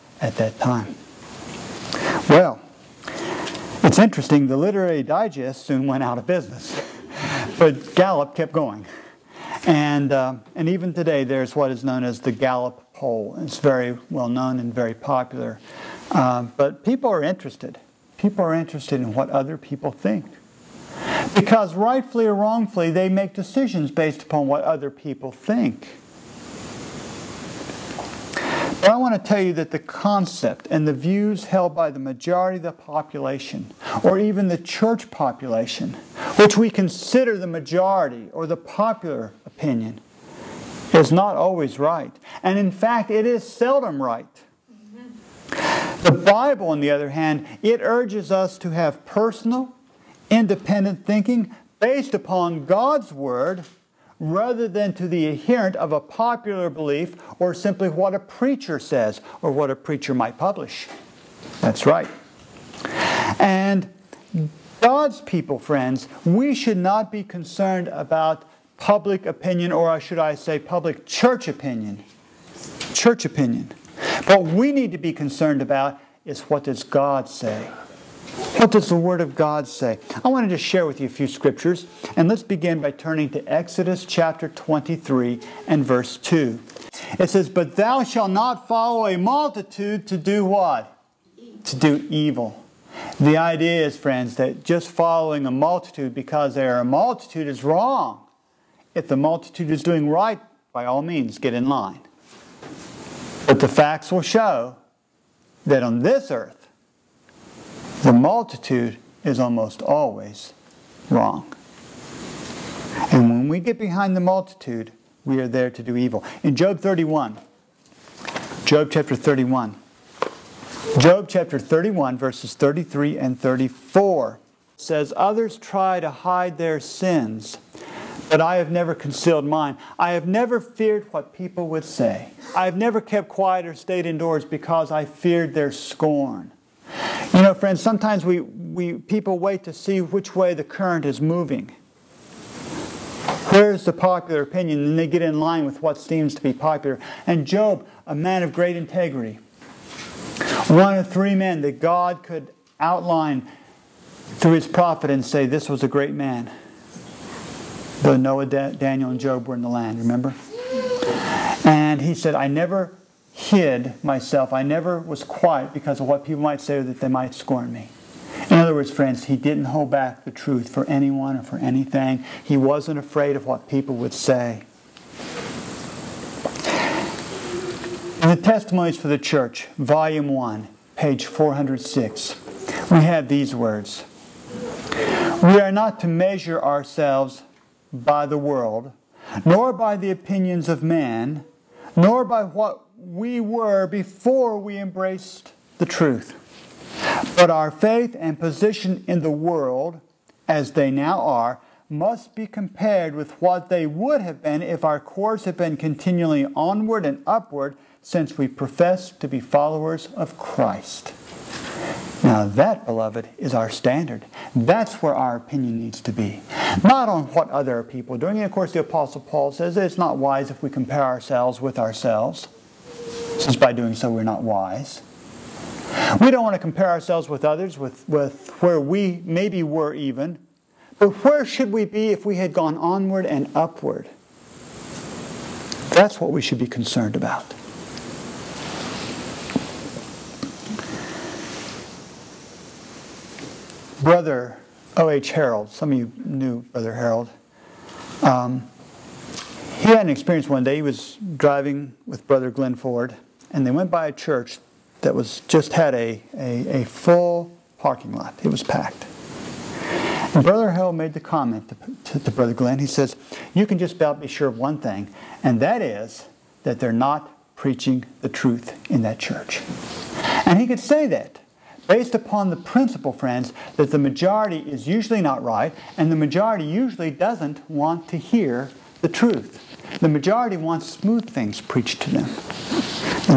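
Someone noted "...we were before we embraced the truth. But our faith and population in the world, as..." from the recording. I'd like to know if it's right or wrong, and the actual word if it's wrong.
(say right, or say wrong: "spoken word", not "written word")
wrong: "position", not "population".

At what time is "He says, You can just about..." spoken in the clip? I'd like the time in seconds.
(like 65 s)
262 s.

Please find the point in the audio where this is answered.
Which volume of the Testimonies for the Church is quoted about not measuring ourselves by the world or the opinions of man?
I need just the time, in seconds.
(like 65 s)
179 s.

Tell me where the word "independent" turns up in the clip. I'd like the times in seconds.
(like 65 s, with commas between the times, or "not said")
50 s.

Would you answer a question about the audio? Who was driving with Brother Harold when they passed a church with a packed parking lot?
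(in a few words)
Glenn Ford.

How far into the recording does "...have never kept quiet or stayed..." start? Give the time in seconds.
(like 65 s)
132 s.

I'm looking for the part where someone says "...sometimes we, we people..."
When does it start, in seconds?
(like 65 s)
137 s.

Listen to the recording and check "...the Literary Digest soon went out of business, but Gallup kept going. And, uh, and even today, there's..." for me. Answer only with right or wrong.
right.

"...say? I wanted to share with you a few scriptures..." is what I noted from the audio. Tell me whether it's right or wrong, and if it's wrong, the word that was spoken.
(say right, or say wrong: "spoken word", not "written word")
right.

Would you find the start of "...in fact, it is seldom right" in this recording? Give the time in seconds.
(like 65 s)
42 s.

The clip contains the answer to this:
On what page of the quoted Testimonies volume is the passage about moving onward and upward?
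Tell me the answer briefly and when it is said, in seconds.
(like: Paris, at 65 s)
406, at 180 s.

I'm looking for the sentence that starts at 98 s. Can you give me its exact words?
If the multitude is doing right, by all means, get in line.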